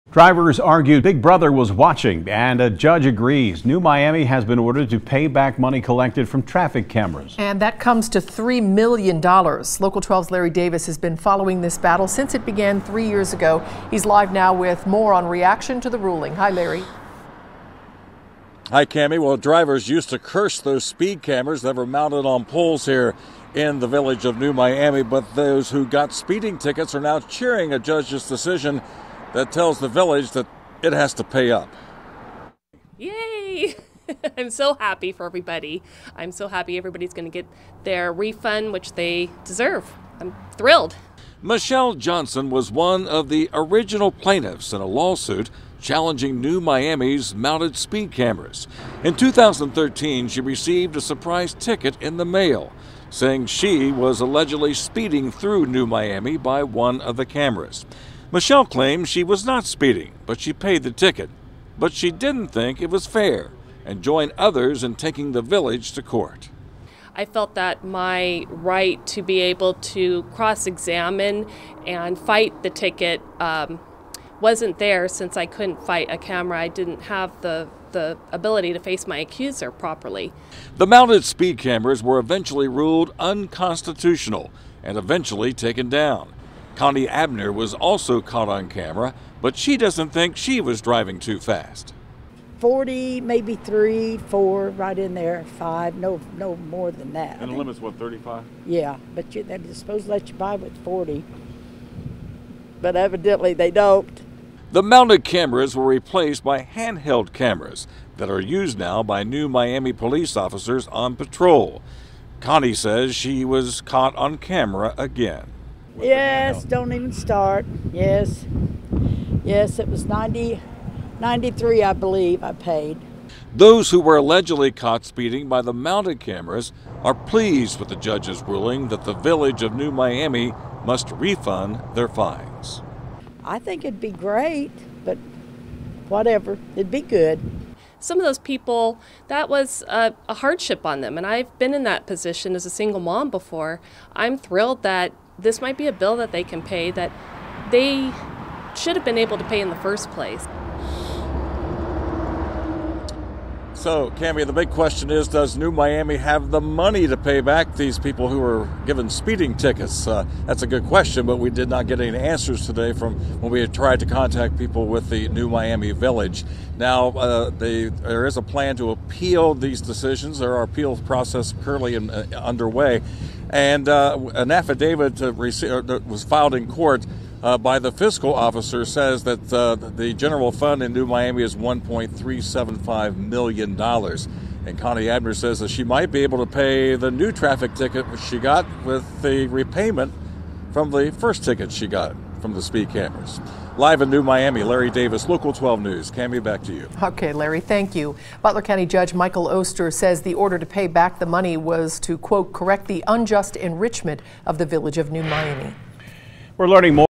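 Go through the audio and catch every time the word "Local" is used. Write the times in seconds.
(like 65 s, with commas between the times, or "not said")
9 s, 195 s.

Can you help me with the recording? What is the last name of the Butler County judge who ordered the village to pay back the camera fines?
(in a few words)
Oester.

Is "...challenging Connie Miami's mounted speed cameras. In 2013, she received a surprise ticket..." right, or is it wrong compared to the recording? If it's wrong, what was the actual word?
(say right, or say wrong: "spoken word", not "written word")
wrong: "New", not "Connie".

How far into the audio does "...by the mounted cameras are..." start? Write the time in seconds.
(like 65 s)
125 s.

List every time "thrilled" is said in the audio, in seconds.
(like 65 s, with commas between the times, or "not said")
40 s, 144 s.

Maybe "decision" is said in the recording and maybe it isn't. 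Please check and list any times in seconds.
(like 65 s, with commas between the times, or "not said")
28 s, 169 s.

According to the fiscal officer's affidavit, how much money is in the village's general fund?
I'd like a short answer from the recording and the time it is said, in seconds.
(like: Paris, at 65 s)
$1.375 million, at 181 s.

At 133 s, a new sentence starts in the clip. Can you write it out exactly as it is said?
I think it'd be great, but whatever, it'd be good.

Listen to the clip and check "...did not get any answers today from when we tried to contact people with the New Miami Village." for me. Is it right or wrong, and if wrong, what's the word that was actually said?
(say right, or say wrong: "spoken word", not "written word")
right.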